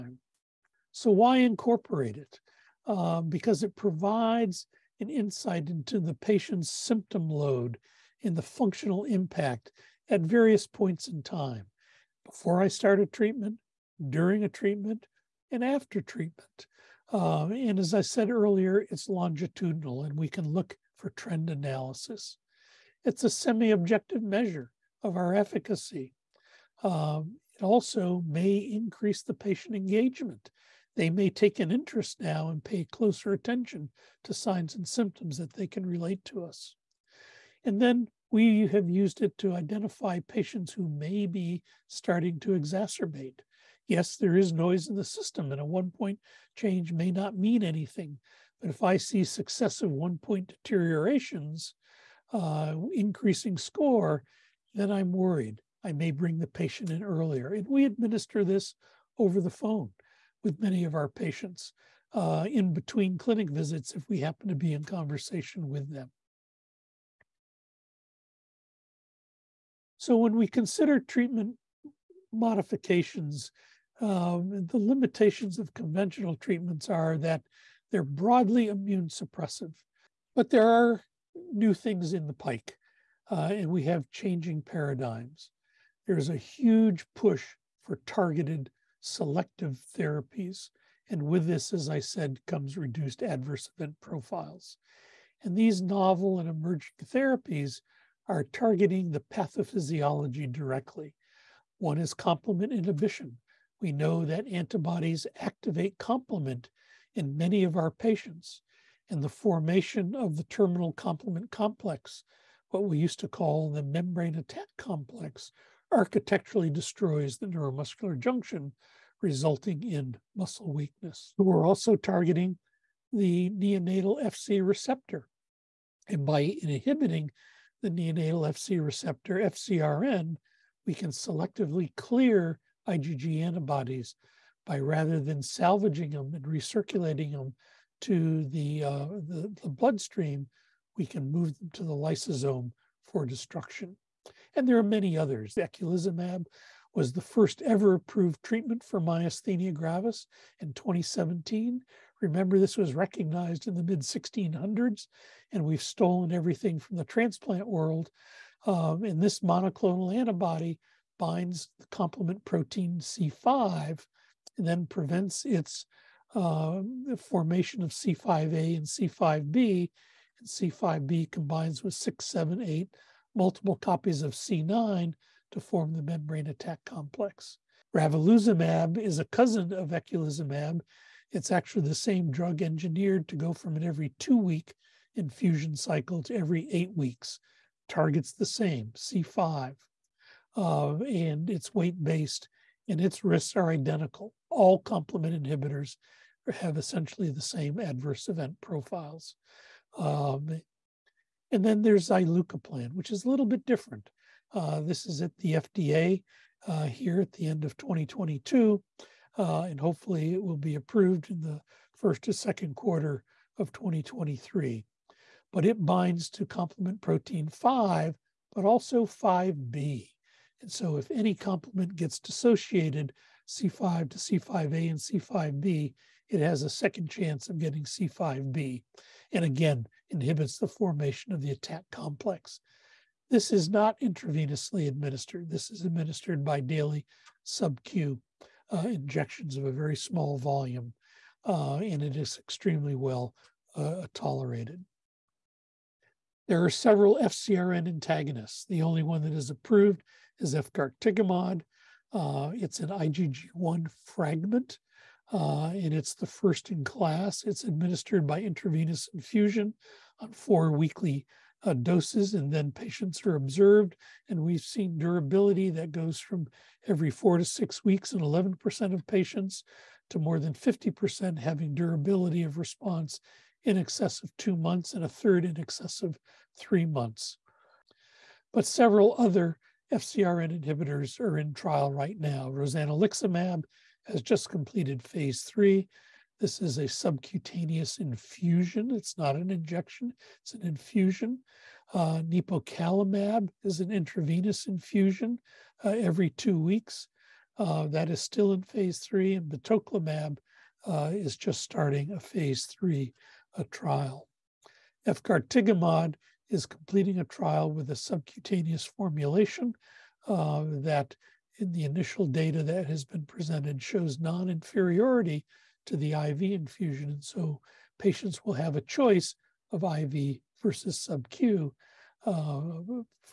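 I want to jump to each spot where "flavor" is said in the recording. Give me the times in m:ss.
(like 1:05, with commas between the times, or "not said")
not said.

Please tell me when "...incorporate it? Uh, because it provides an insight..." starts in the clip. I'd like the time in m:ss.
0:01.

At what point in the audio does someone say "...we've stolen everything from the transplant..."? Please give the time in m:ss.
2:35.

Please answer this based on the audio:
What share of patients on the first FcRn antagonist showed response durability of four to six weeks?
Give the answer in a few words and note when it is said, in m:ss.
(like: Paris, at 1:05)
11%, at 4:28.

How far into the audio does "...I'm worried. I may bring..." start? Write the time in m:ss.
0:54.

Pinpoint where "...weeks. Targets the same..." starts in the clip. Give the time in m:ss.
3:06.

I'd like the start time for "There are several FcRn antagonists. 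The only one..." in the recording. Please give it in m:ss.
4:06.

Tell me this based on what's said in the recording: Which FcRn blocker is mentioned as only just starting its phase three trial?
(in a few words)
batoclimab.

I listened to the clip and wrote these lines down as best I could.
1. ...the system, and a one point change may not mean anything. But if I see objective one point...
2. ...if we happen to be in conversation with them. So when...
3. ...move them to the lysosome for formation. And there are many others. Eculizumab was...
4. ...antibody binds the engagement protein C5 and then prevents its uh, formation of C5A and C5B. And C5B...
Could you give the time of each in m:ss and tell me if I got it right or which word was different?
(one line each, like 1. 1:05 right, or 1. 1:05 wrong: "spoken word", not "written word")
1. 0:44 wrong: "successive", not "objective"
2. 1:03 right
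3. 2:21 wrong: "destruction", not "formation"
4. 2:40 wrong: "complement", not "engagement".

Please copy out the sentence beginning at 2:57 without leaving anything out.
Ravulizumab is a cousin of eculizumab.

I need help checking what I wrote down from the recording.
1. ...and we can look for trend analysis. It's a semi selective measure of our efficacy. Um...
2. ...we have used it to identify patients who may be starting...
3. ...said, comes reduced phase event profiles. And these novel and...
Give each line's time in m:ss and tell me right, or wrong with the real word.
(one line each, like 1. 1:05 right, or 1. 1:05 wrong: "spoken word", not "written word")
1. 0:20 wrong: "objective", not "selective"
2. 0:38 right
3. 1:31 wrong: "adverse", not "phase".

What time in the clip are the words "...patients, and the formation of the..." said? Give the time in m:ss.
1:47.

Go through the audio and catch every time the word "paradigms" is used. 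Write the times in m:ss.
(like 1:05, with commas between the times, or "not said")
1:24.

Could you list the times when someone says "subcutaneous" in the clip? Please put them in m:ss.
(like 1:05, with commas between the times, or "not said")
4:46, 5:07.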